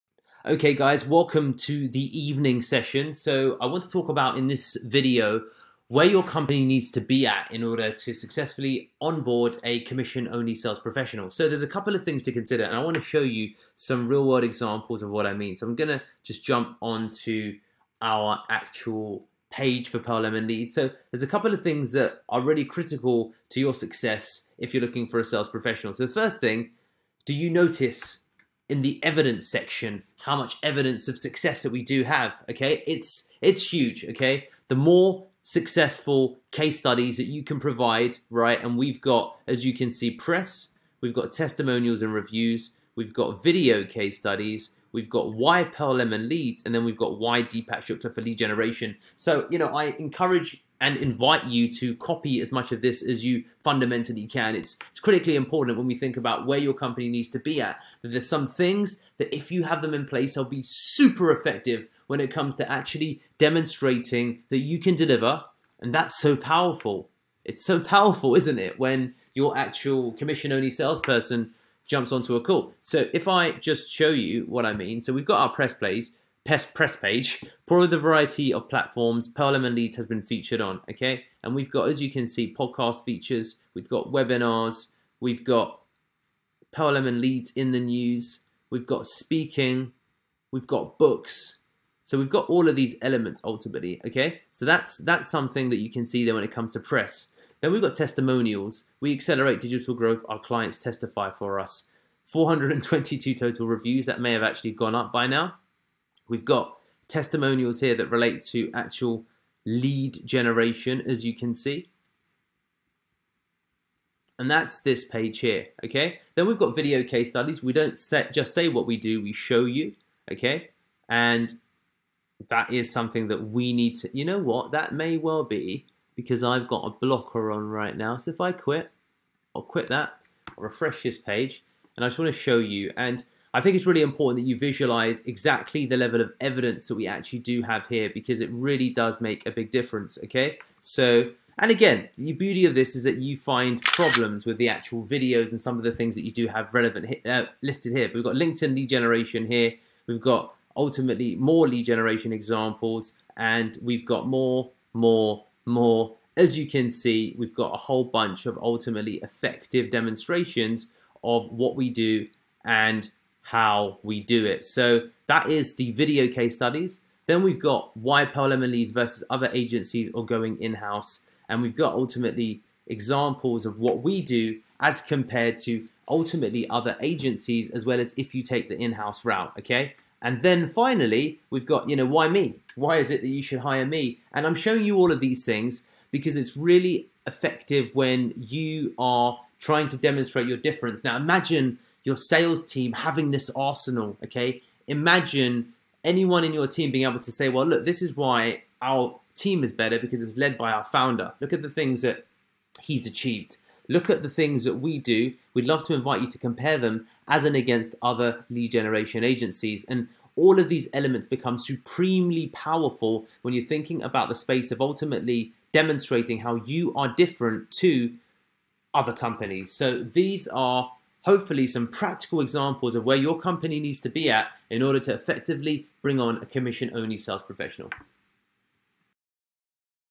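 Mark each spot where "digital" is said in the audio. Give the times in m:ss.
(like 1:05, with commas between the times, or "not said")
1:39.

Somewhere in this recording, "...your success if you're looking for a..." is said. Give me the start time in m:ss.
0:23.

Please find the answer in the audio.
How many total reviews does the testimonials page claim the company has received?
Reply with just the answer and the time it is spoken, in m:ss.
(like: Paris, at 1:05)
422, at 1:42.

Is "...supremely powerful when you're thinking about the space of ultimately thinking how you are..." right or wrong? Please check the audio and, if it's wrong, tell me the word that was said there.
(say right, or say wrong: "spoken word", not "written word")
wrong: "demonstrating", not "thinking".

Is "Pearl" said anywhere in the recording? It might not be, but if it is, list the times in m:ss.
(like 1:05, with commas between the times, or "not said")
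0:19, 0:45, 1:19, 1:26, 2:48.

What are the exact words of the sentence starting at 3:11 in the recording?
Now imagine your sales team having this arsenal, okay?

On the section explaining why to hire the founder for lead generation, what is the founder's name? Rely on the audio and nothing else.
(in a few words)
Deepak Shukla.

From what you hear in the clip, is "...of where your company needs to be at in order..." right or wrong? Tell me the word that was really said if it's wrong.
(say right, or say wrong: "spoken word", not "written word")
right.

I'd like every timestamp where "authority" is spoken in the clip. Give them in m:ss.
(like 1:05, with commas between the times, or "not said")
not said.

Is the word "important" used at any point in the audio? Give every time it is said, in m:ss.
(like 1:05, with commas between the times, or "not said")
0:55, 2:14.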